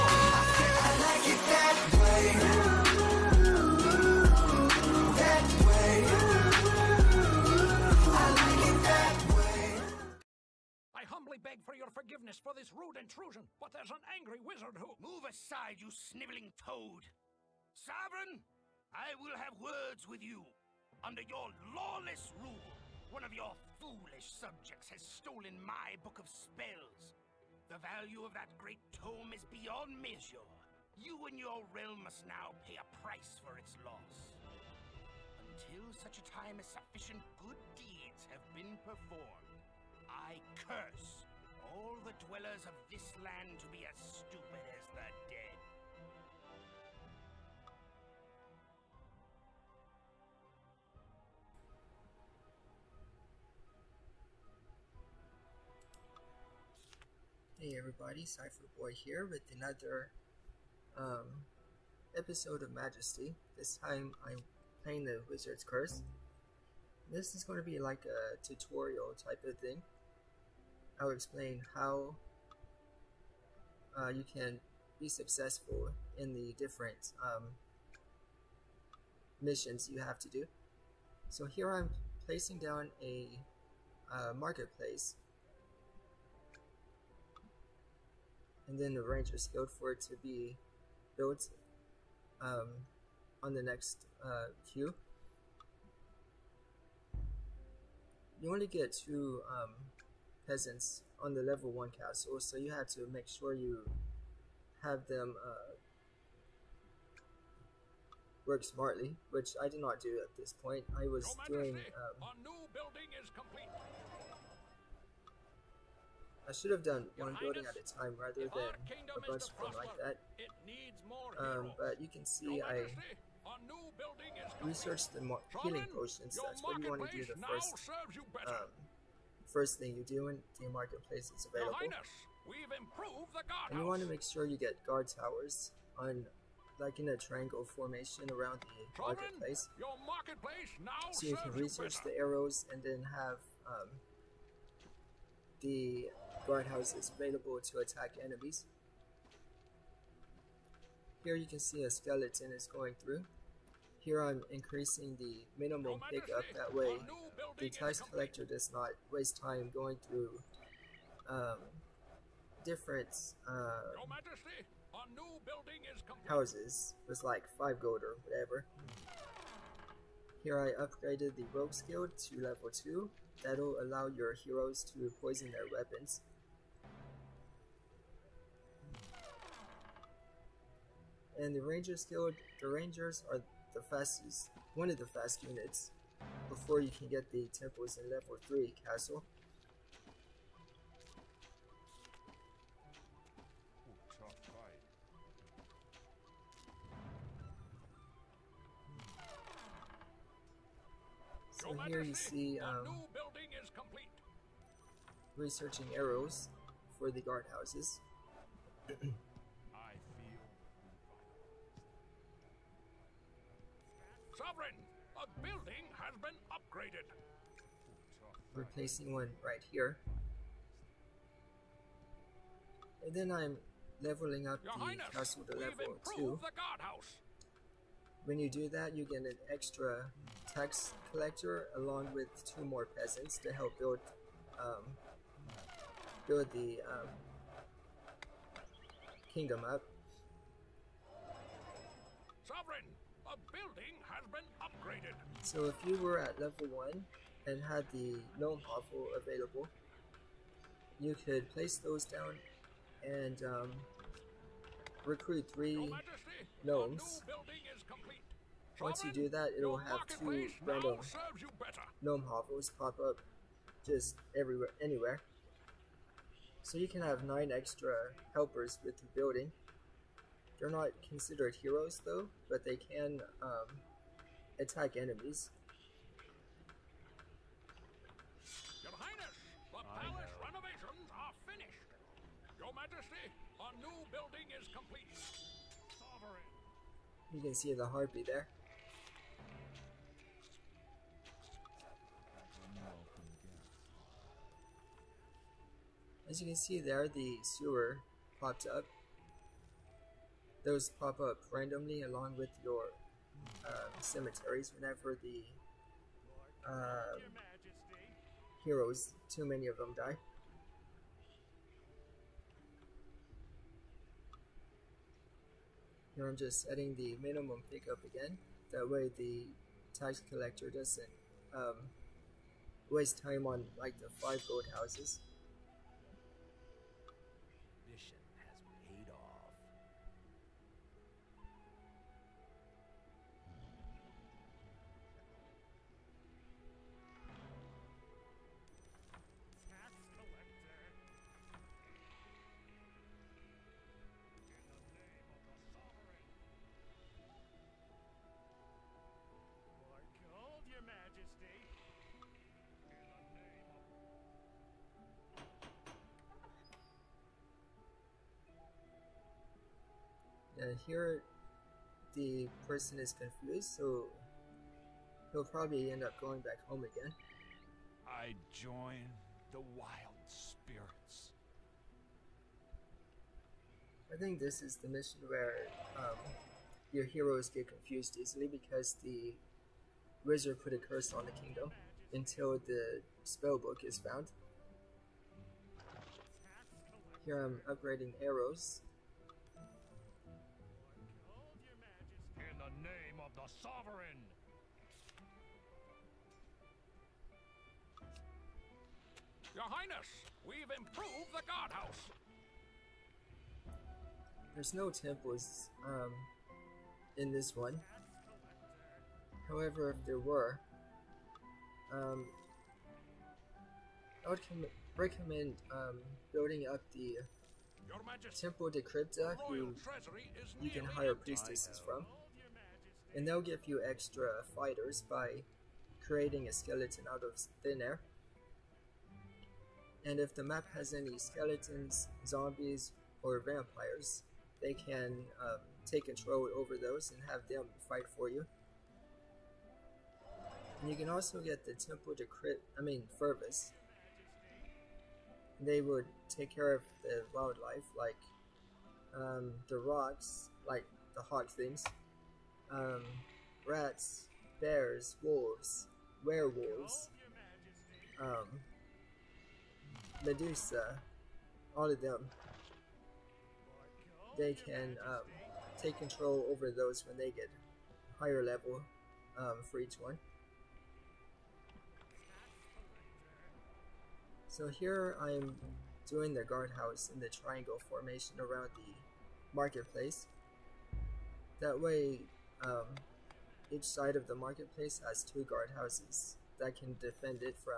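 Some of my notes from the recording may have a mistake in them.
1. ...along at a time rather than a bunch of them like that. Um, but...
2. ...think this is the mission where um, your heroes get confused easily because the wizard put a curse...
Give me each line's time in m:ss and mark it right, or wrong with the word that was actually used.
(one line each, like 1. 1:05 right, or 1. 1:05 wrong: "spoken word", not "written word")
1. 1:57 wrong: "building", not "along"
2. 6:14 right.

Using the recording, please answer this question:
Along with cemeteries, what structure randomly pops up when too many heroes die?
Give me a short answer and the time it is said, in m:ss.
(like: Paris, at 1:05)
Sewer, at 4:57.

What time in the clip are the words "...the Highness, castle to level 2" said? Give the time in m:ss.
3:44.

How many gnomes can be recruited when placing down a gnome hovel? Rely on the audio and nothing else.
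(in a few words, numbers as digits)
3.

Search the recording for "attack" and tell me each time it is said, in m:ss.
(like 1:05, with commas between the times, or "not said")
2:27, 4:34.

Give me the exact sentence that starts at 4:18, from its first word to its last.
Once you do that, it'll have two random gnome hovels pop up just everywhere, anywhere.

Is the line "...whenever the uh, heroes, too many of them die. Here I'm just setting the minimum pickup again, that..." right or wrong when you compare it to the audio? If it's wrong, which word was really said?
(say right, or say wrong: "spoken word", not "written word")
right.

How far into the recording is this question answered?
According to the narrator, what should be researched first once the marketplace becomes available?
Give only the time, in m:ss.
2:05.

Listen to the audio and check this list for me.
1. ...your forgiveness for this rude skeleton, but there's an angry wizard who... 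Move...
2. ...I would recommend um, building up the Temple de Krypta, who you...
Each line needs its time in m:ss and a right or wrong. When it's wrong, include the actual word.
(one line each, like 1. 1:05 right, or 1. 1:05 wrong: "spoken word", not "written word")
1. 0:11 wrong: "intrusion", not "skeleton"
2. 6:54 right.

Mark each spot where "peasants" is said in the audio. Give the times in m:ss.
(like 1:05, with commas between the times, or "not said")
1:40, 3:52.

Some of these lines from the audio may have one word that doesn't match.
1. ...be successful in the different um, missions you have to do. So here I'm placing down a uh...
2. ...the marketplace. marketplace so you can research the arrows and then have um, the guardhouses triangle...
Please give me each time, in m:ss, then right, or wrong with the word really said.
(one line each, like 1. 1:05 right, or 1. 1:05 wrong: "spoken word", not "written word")
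1. 1:14 right
2. 2:18 wrong: "available", not "triangle".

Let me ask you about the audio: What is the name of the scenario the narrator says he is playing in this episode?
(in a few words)
The Wizard's Curse.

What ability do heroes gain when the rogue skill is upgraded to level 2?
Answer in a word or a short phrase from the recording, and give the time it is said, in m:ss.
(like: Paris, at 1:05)
Poison their weapons, at 2:55.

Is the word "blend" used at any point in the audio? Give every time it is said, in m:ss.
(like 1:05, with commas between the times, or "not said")
not said.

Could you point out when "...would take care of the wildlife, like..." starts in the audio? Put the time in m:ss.
7:25.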